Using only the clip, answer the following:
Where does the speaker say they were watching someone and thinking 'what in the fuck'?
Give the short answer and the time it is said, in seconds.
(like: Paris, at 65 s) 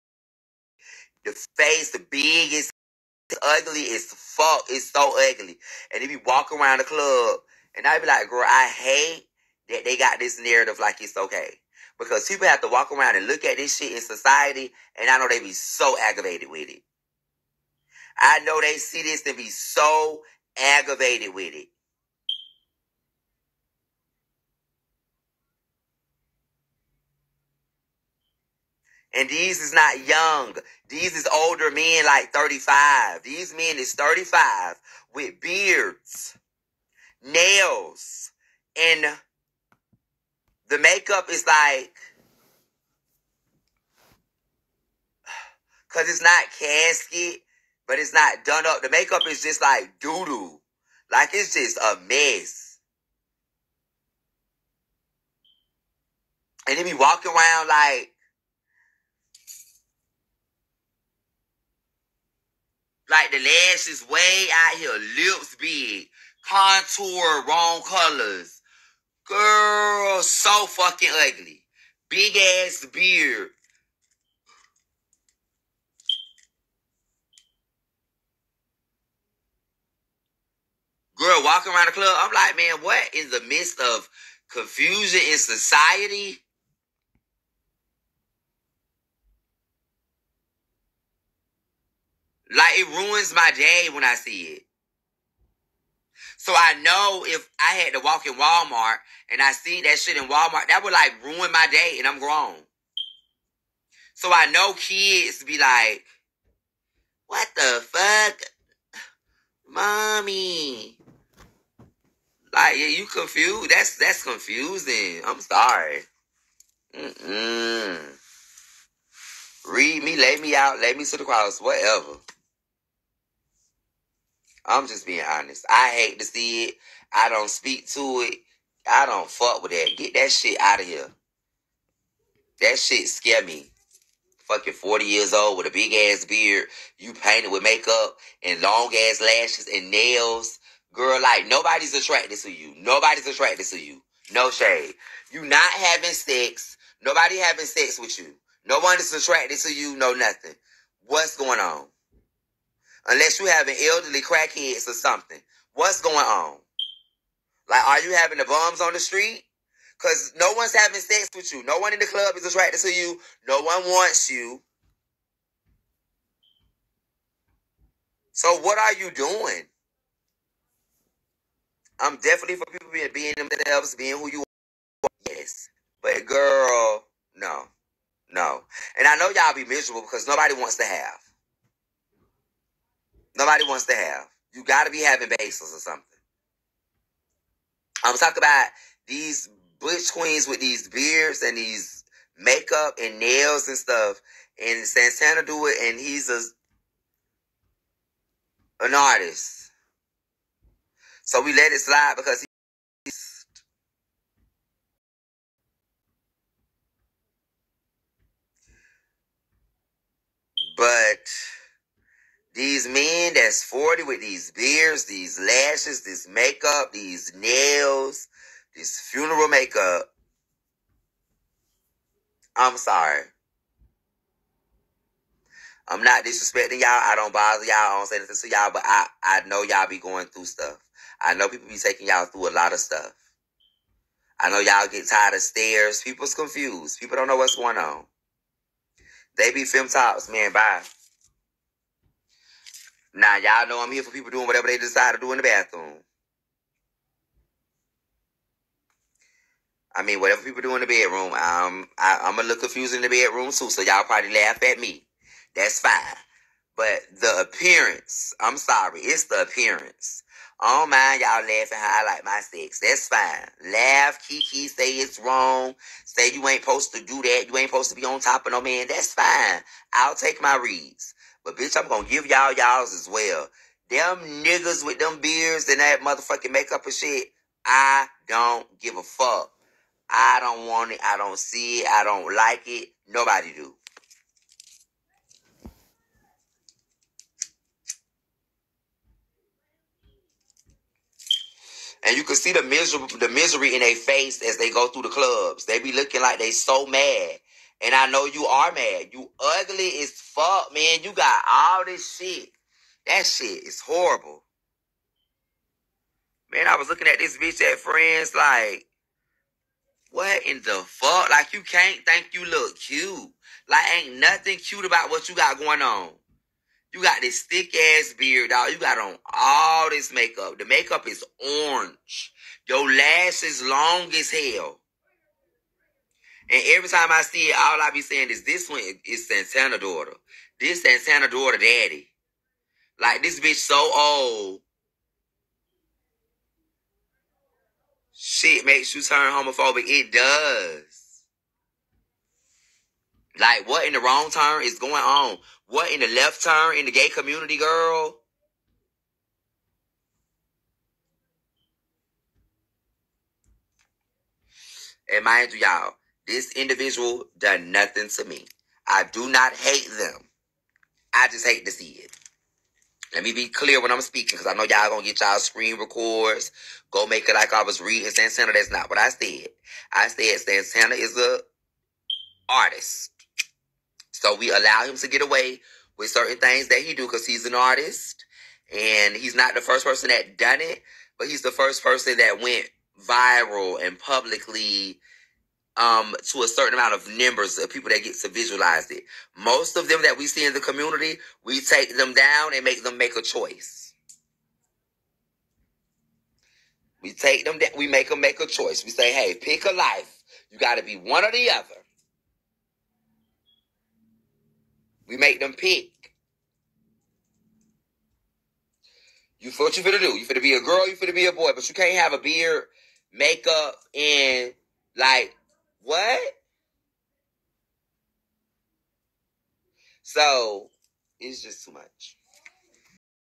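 Friends, at 307 s.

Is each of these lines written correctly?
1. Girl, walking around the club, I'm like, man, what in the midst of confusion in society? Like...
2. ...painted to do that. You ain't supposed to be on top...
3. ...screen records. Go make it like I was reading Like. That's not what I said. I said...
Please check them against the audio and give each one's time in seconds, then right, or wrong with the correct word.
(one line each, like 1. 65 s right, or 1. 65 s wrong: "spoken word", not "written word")
1. 81 s right
2. 266 s wrong: "supposed", not "painted"
3. 365 s wrong: "Santana", not "Like".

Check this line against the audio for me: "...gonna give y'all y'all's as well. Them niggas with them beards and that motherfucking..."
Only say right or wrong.
right.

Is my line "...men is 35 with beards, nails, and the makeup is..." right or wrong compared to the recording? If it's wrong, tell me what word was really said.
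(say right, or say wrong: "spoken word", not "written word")
right.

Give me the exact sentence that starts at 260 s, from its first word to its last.
I don't oh mind y'all laughing how I like my sex.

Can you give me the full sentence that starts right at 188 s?
I'm talking about these butch queens with these beards and these makeup and nails and stuff.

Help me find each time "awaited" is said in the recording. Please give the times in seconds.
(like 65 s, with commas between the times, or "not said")
not said.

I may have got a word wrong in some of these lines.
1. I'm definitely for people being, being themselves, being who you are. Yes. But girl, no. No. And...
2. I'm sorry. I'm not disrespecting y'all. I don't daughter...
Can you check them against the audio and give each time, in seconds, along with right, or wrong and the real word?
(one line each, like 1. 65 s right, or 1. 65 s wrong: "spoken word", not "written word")
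1. 171 s right
2. 222 s wrong: "bother", not "daughter".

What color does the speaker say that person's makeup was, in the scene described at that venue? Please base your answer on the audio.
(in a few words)
Orange.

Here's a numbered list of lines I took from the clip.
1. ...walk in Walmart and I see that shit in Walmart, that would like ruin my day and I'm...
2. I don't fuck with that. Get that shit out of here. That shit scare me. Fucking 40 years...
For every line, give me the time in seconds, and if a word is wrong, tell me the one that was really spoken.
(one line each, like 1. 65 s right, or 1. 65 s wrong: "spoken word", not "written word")
1. 98 s right
2. 128 s right.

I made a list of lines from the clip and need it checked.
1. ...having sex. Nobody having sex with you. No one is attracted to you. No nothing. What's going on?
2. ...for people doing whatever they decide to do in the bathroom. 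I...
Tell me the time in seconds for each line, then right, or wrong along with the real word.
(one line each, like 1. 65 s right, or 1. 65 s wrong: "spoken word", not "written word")
1. 145 s right
2. 244 s right.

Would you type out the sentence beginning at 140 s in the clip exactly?
Girl, like nobody's attracted to you.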